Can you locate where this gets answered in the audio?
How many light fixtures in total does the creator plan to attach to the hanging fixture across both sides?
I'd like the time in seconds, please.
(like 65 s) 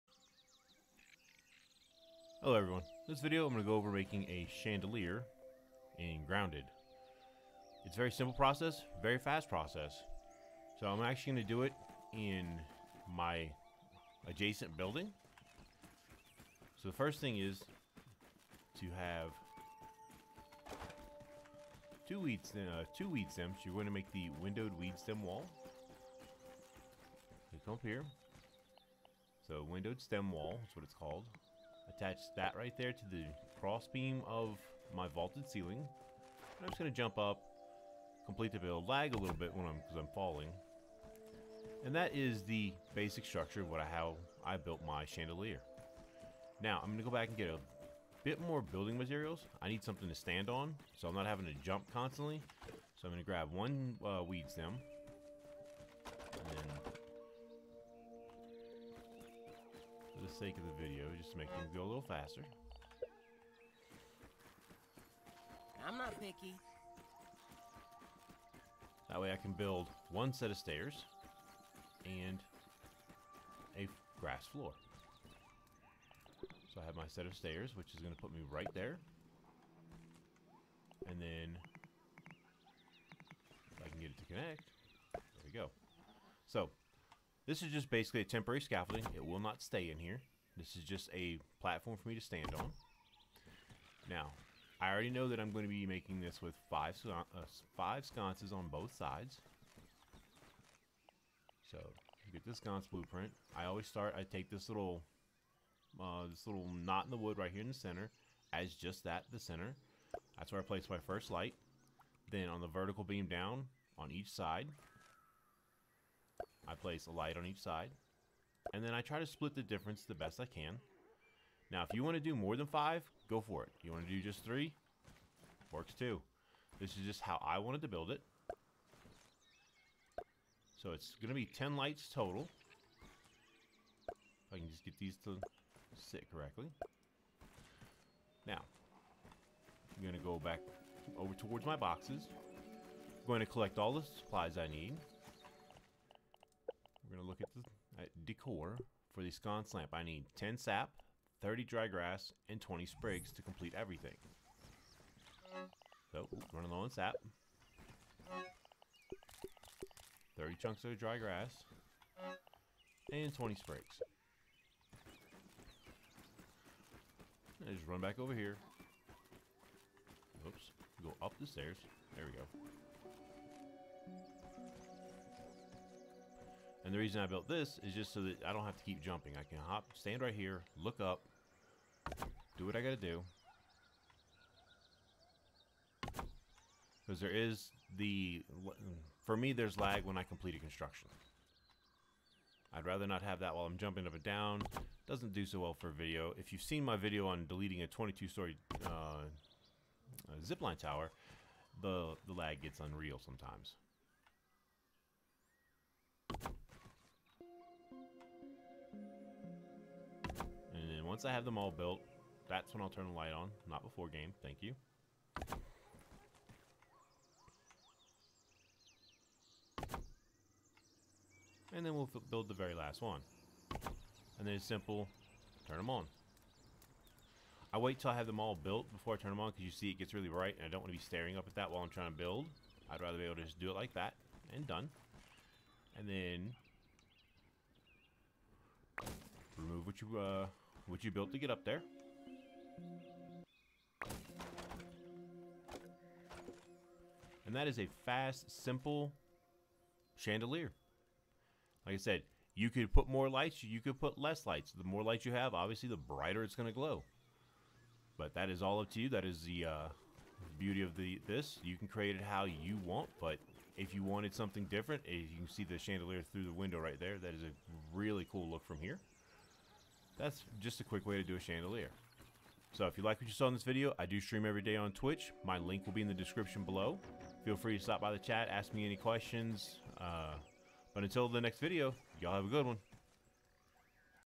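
131 s.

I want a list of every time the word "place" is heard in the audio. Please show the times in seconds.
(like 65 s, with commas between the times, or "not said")
110 s, 116 s.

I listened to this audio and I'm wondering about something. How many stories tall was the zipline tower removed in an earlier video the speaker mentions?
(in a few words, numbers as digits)
22.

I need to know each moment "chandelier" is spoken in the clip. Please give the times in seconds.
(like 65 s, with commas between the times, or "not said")
4 s, 45 s, 250 s, 265 s, 271 s.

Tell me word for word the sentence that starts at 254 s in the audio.
The more lights you have, obviously, the brighter it's going to glow.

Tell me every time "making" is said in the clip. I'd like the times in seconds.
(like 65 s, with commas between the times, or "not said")
3 s, 95 s.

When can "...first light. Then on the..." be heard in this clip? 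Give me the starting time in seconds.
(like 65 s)
111 s.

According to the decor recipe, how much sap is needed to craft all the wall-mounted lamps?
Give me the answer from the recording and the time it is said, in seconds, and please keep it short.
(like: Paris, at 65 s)
10 sap, at 150 s.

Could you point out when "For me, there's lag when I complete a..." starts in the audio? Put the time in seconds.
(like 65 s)
189 s.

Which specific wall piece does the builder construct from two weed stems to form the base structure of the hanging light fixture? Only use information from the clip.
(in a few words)
windowed stem wall.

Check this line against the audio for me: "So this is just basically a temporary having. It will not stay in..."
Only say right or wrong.
wrong.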